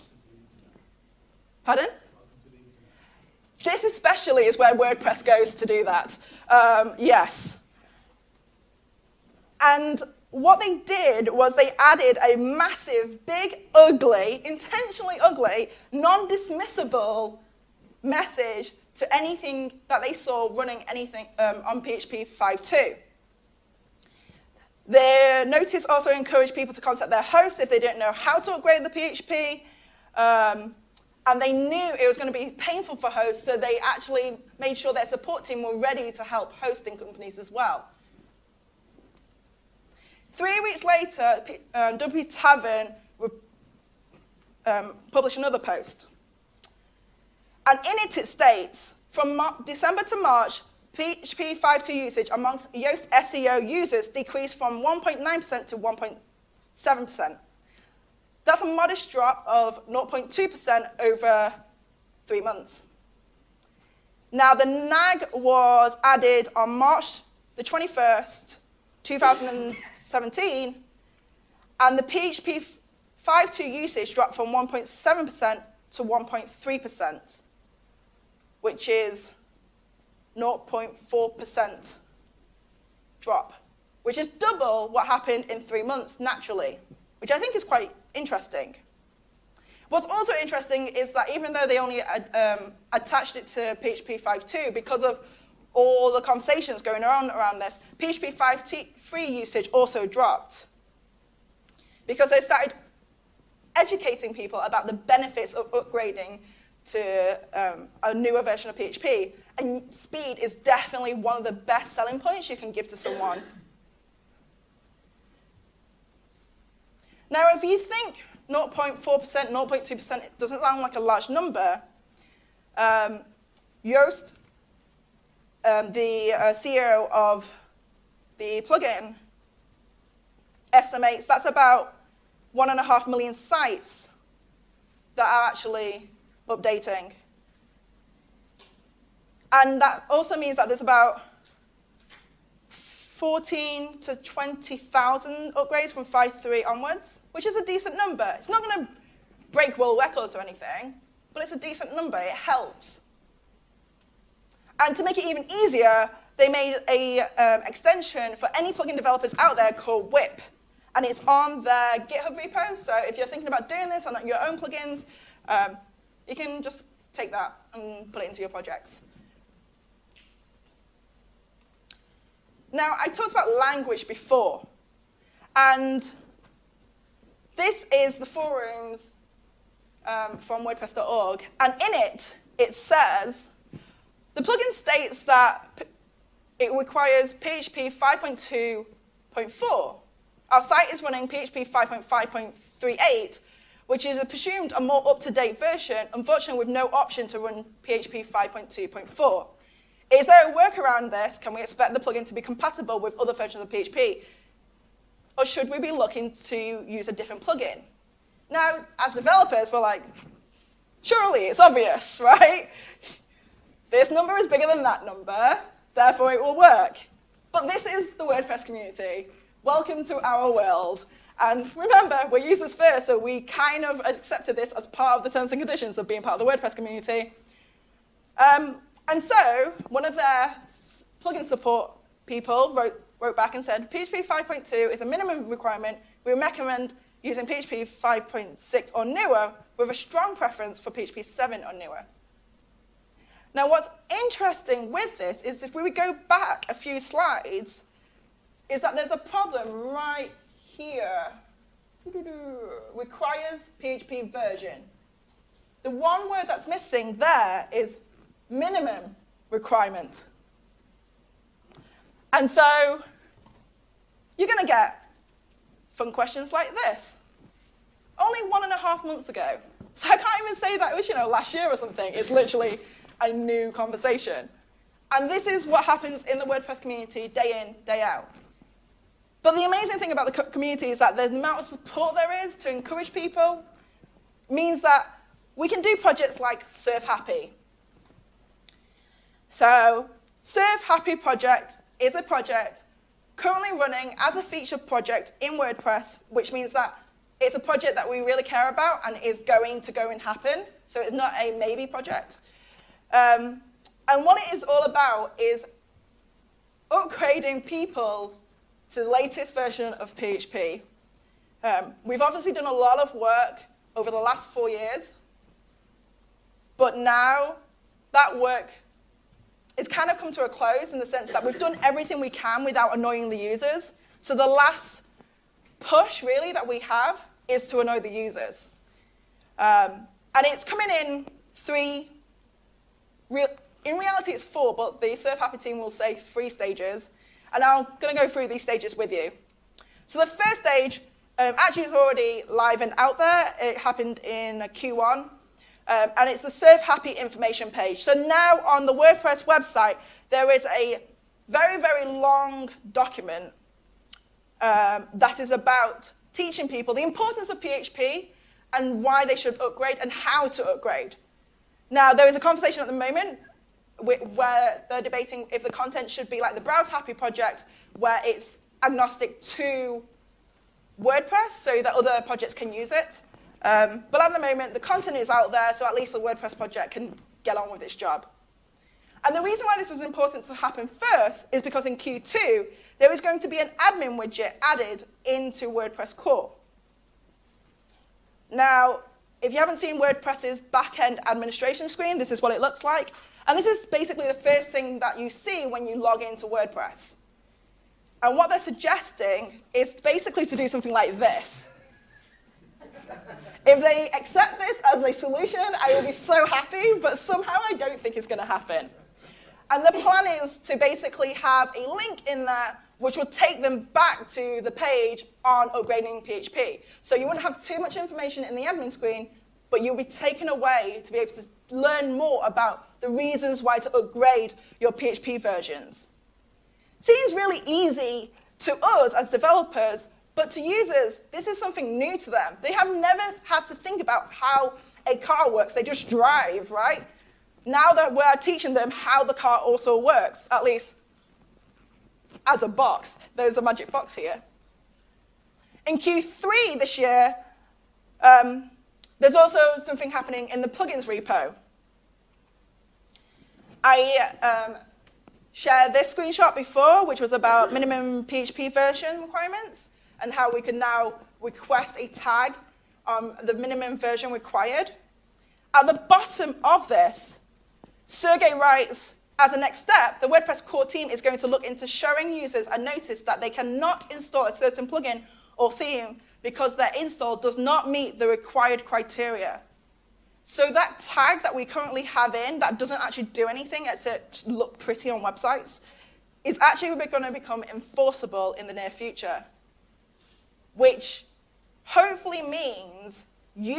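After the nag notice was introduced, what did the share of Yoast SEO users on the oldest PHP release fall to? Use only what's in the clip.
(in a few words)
1.3%.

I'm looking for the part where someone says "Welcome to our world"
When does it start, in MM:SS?
03:39.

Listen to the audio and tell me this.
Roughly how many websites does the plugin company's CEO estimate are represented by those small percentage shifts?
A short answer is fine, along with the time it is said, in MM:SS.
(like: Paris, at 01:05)
1.5 million, at 02:12.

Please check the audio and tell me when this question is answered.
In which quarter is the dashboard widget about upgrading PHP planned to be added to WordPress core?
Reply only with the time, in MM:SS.
06:21.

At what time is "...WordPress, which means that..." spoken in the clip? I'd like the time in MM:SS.
04:55.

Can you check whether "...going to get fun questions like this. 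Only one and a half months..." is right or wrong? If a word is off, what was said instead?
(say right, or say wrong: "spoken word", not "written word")
right.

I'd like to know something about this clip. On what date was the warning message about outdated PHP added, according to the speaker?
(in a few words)
March 21, 2017.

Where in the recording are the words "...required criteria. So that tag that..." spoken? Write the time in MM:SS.
07:58.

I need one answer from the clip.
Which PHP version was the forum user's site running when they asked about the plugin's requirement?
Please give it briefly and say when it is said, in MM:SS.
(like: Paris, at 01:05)
5.5.38, at 03:11.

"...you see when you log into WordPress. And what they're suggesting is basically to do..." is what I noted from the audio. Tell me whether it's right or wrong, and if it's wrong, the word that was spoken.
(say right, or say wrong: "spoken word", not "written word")
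right.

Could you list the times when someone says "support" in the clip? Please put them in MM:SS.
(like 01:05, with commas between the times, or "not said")
00:35, 03:51, 04:41.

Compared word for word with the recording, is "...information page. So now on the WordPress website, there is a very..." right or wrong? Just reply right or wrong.
right.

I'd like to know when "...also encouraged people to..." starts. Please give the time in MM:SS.
00:25.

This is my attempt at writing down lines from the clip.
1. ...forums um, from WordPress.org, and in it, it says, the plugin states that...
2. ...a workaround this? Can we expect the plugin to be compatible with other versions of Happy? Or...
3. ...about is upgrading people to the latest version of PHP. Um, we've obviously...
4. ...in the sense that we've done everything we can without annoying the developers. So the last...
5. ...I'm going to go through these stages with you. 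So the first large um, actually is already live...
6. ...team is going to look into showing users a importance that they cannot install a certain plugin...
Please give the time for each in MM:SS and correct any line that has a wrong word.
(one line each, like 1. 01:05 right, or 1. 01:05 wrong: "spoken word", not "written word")
1. 02:58 right
2. 03:20 wrong: "PHP", not "Happy"
3. 05:04 right
4. 05:20 wrong: "users", not "developers"
5. 05:37 wrong: "stage", not "large"
6. 07:50 wrong: "notice", not "importance".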